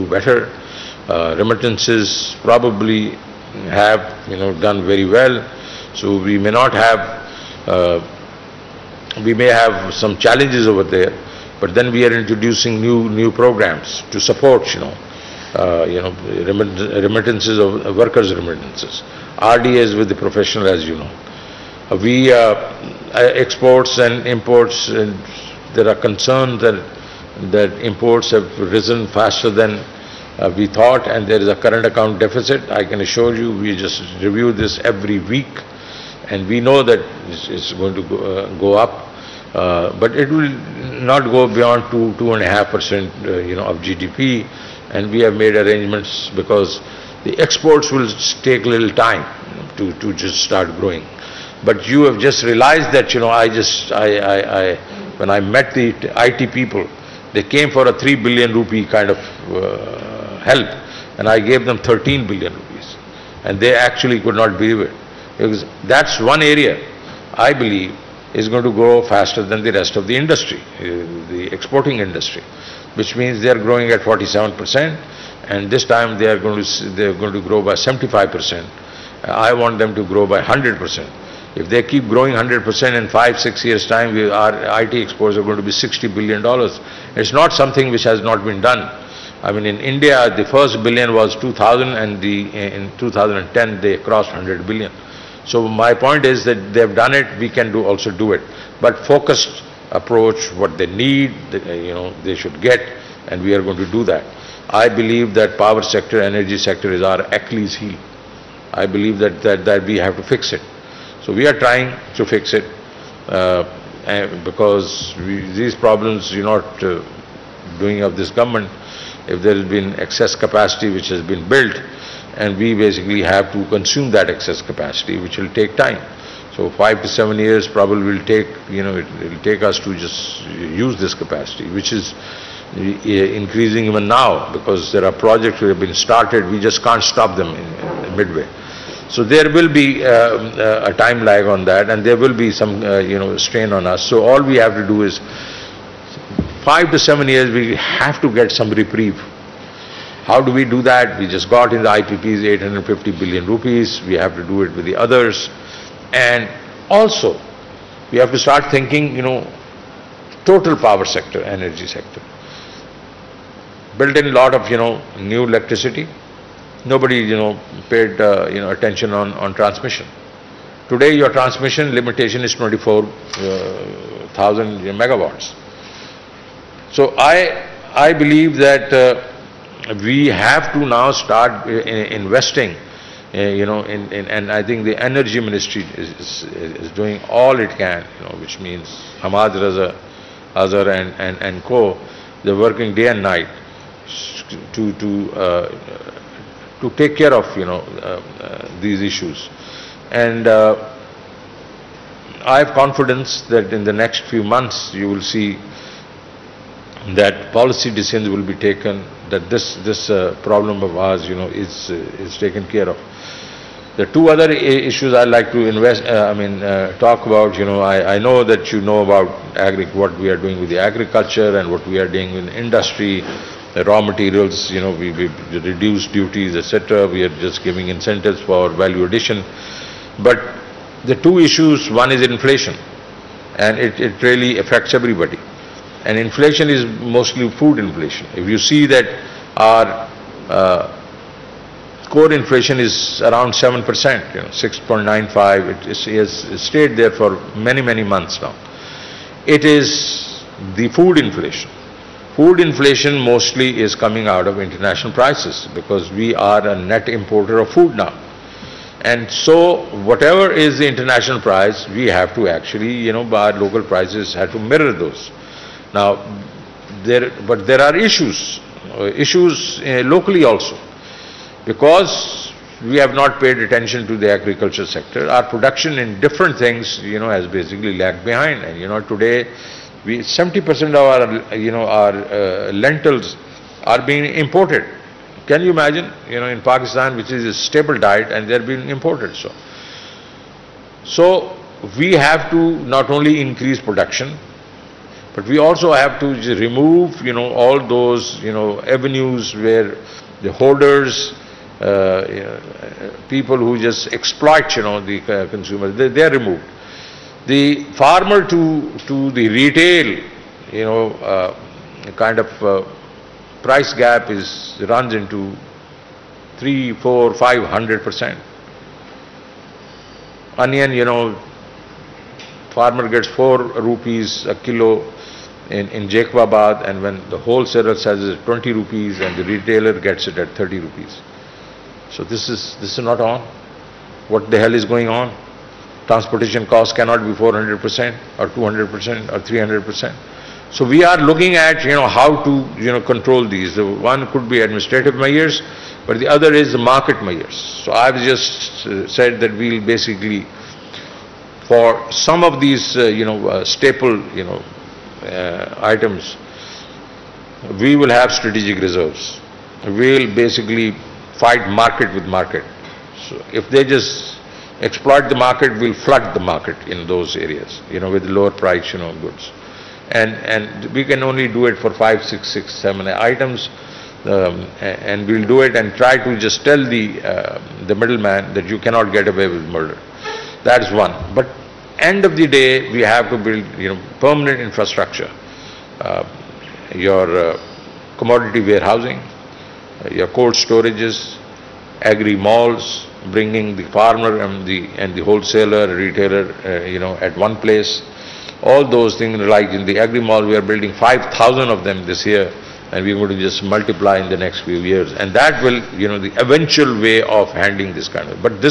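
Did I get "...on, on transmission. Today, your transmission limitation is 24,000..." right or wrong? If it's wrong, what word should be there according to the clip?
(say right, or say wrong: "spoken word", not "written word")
right.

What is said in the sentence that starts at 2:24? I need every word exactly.
So all we have to do is five to seven years, we have to get some reprieve.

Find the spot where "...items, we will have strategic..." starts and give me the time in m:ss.
5:55.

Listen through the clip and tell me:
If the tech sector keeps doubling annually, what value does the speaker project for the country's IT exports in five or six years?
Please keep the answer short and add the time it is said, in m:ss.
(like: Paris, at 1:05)
$60 billion, at 1:25.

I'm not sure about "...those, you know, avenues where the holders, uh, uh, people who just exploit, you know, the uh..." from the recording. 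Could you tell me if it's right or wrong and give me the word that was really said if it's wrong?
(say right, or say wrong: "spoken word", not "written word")
right.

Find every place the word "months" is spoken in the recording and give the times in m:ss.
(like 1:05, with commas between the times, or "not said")
3:24, 4:08.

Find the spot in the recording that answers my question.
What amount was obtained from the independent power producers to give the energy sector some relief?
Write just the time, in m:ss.
2:32.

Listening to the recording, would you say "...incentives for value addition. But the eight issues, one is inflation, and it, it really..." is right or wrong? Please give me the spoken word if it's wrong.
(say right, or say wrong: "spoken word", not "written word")
wrong: "two", not "eight".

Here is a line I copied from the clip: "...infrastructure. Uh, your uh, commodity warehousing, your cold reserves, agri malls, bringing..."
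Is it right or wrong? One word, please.
wrong.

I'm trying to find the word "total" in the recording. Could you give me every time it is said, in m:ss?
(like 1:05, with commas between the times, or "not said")
2:40.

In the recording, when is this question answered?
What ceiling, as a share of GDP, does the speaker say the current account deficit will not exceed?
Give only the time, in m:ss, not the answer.
0:42.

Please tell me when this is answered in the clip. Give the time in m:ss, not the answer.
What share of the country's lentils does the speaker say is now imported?
4:40.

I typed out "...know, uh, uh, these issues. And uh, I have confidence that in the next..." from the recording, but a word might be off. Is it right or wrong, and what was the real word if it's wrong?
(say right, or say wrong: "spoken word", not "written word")
right.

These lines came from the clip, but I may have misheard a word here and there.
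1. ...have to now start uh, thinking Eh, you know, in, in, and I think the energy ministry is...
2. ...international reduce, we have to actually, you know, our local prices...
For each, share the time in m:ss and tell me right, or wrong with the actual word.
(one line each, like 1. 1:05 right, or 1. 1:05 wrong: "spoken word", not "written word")
1. 3:00 wrong: "investing", not "thinking"
2. 4:20 wrong: "price", not "reduce".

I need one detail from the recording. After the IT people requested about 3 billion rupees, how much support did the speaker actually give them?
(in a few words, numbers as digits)
13 billion rupees.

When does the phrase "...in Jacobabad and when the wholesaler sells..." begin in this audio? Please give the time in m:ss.
5:25.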